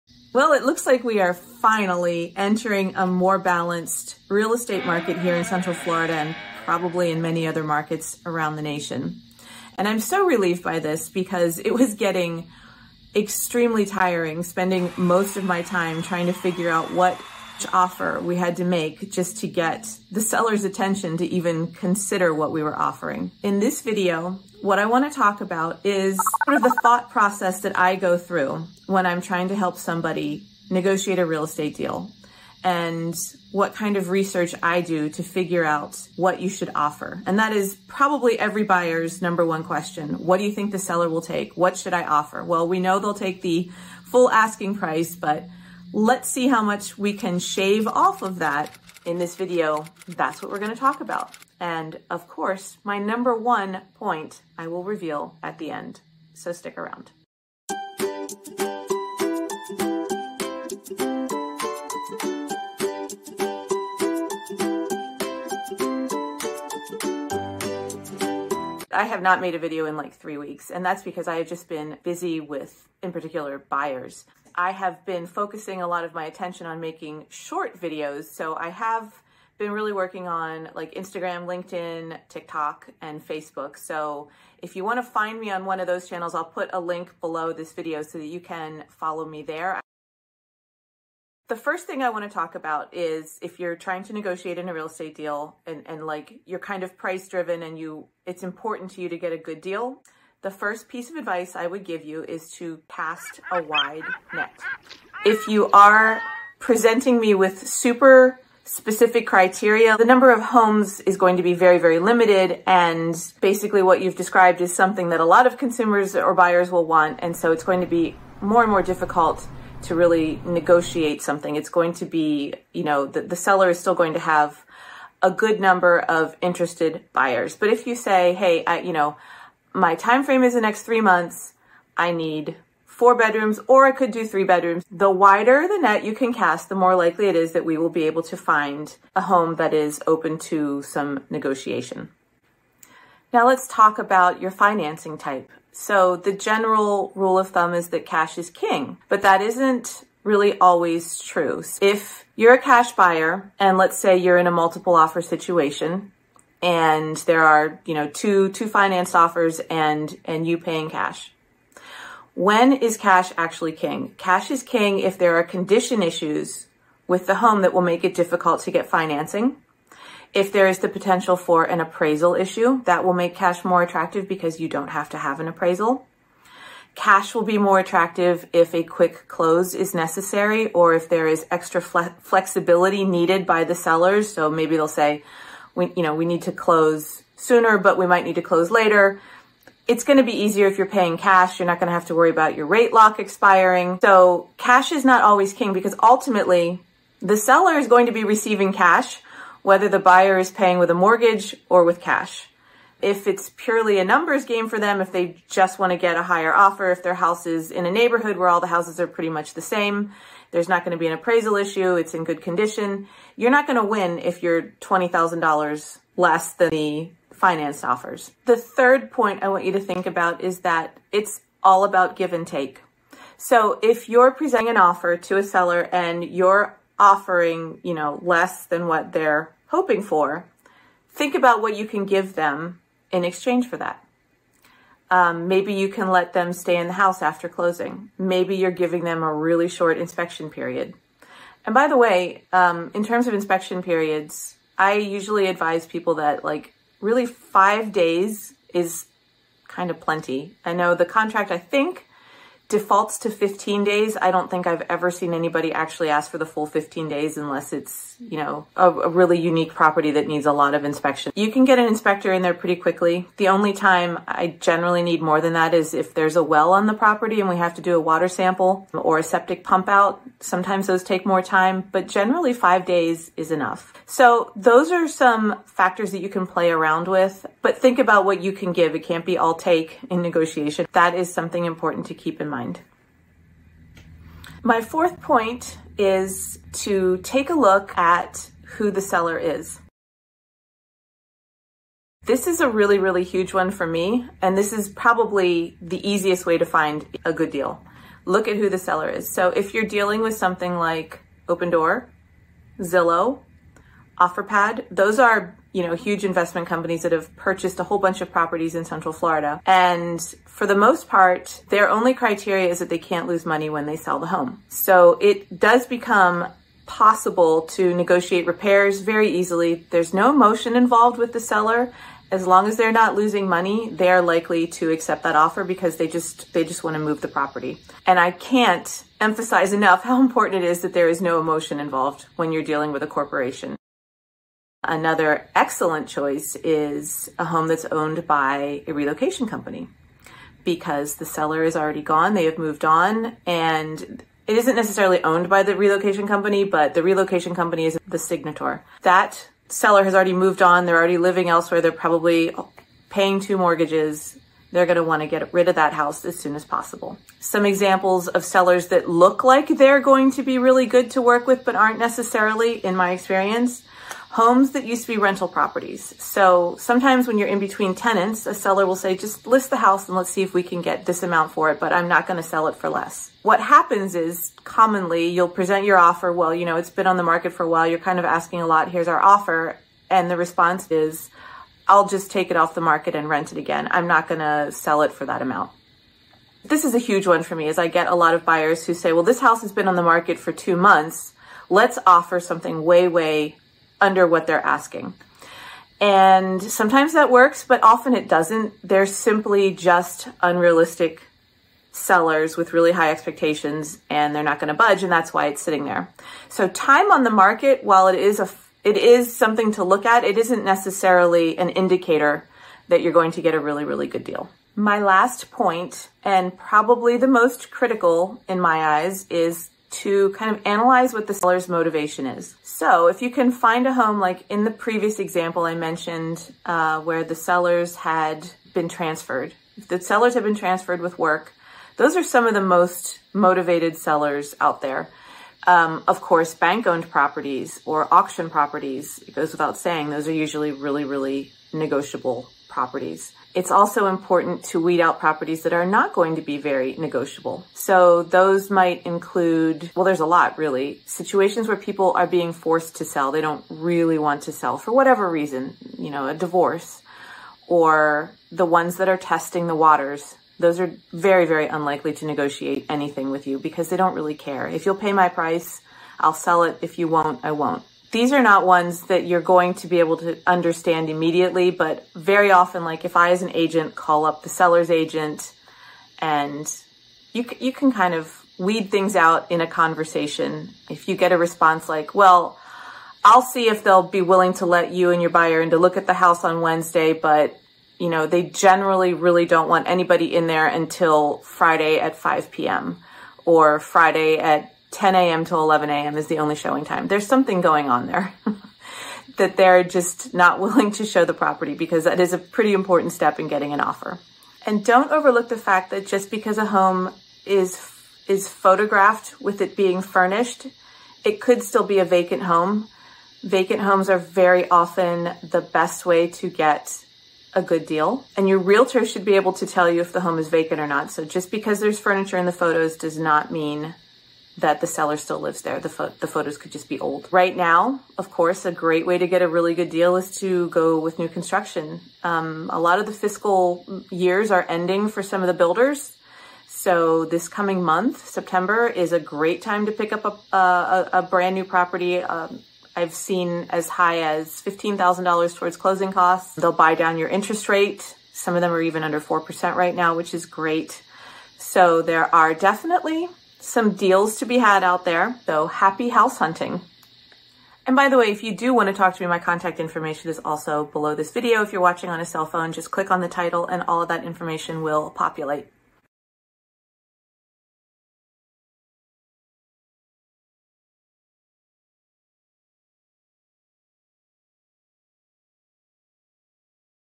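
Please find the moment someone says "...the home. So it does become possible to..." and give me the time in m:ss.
5:14.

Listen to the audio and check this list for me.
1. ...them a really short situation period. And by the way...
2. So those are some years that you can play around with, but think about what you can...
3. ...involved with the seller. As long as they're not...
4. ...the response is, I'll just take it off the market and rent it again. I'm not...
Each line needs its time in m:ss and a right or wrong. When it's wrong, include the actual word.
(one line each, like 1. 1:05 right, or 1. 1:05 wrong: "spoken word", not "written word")
1. 3:59 wrong: "inspection", not "situation"
2. 4:34 wrong: "factors", not "years"
3. 5:20 right
4. 6:20 right.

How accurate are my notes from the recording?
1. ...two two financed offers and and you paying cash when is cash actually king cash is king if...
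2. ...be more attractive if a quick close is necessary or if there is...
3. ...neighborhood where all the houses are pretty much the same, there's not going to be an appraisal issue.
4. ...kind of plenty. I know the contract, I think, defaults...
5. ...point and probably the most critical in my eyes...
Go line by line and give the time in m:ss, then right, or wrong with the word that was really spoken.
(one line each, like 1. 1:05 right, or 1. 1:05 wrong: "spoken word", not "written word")
1. 2:38 right
2. 2:57 right
3. 3:27 right
4. 4:09 right
5. 6:55 right.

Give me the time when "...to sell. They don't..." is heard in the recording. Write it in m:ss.
7:32.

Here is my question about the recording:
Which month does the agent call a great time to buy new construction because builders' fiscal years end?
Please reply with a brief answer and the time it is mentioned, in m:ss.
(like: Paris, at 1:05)
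September, at 8:58.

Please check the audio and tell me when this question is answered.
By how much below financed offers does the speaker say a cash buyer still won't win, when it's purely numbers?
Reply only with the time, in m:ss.
3:34.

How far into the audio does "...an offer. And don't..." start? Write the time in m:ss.
8:23.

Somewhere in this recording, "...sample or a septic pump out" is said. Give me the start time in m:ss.
4:28.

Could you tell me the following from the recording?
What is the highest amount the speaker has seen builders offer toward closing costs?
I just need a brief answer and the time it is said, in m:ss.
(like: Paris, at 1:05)
$15,000, at 9:04.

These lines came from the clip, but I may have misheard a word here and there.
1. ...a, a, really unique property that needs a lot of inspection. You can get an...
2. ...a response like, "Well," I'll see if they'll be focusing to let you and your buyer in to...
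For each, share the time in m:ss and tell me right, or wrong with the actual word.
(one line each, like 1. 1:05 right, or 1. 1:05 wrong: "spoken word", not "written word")
1. 4:18 right
2. 8:01 wrong: "willing", not "focusing".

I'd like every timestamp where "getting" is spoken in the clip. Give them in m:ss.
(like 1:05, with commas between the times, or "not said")
0:11, 8:23.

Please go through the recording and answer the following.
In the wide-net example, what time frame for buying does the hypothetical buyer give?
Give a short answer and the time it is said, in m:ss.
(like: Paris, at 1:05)
the next three months, at 2:10.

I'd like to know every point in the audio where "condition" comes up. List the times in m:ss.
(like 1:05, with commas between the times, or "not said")
2:45, 3:32.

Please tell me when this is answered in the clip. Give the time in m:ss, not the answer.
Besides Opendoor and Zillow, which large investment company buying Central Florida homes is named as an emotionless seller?
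5:04.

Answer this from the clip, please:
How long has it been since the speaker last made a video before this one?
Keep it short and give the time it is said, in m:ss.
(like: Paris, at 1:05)
three weeks, at 1:10.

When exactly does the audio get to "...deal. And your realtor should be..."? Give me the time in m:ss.
8:37.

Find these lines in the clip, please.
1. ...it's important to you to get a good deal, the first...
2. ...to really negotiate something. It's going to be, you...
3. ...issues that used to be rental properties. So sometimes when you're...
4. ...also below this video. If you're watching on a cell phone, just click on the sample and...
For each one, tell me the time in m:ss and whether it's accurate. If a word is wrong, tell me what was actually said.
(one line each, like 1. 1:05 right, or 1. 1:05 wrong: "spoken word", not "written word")
1. 1:38 right
2. 1:59 right
3. 6:04 wrong: "homes", not "issues"
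4. 9:20 wrong: "title", not "sample".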